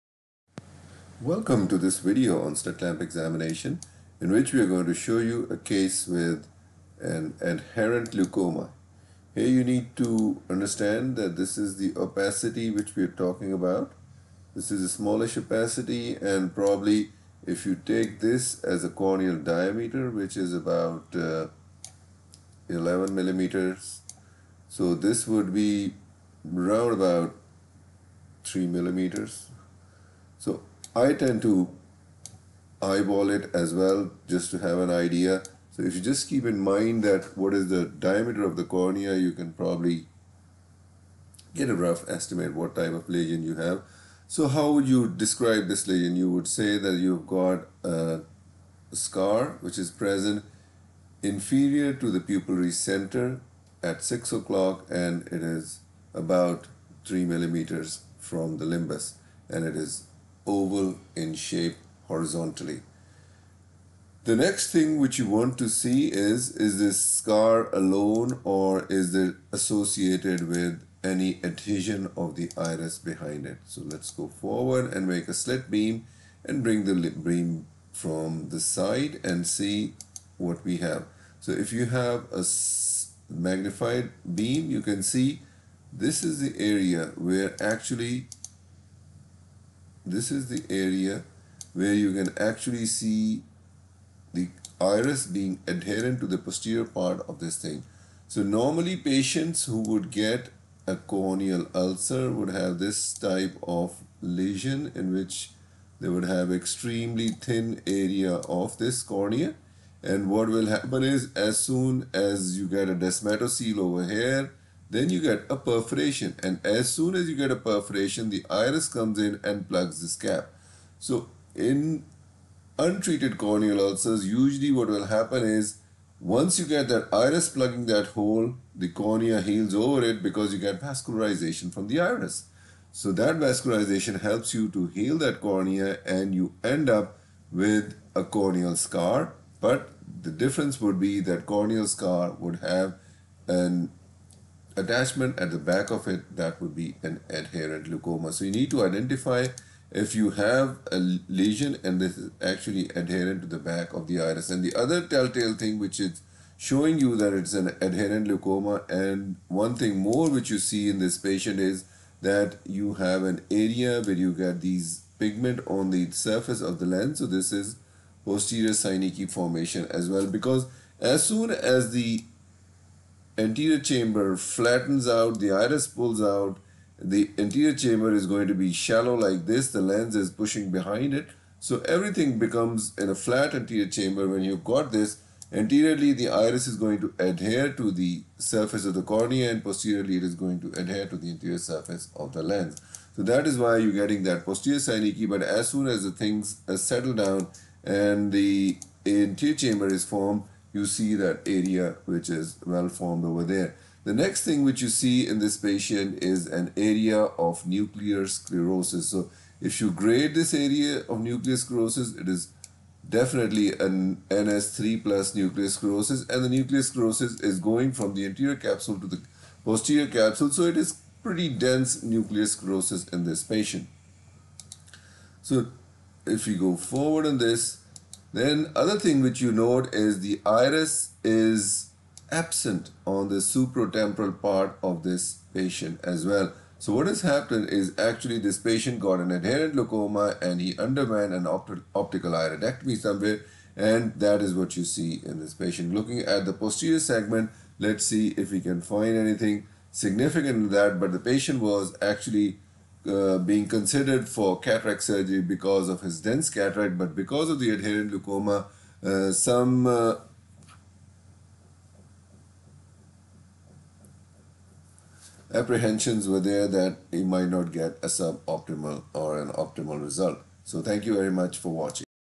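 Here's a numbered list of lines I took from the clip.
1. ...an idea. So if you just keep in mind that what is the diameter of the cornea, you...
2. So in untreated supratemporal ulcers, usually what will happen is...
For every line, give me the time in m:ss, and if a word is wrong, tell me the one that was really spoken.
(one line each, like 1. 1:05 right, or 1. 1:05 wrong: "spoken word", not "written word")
1. 0:34 right
2. 2:00 wrong: "corneal", not "supratemporal".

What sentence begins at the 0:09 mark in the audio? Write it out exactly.
Here you need to understand that this is the opacity which we are talking about.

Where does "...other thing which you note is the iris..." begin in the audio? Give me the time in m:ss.
3:48.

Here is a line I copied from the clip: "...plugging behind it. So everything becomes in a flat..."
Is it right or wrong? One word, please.
wrong.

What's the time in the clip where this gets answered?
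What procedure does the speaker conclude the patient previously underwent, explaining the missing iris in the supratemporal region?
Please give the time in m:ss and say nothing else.
4:01.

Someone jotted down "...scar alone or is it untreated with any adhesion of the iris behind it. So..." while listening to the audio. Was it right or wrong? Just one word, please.
wrong.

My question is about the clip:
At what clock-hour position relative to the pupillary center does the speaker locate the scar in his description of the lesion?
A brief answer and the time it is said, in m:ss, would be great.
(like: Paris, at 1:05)
6 o'clock, at 0:54.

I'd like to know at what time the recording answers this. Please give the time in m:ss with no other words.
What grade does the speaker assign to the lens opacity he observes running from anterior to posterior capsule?
3:34.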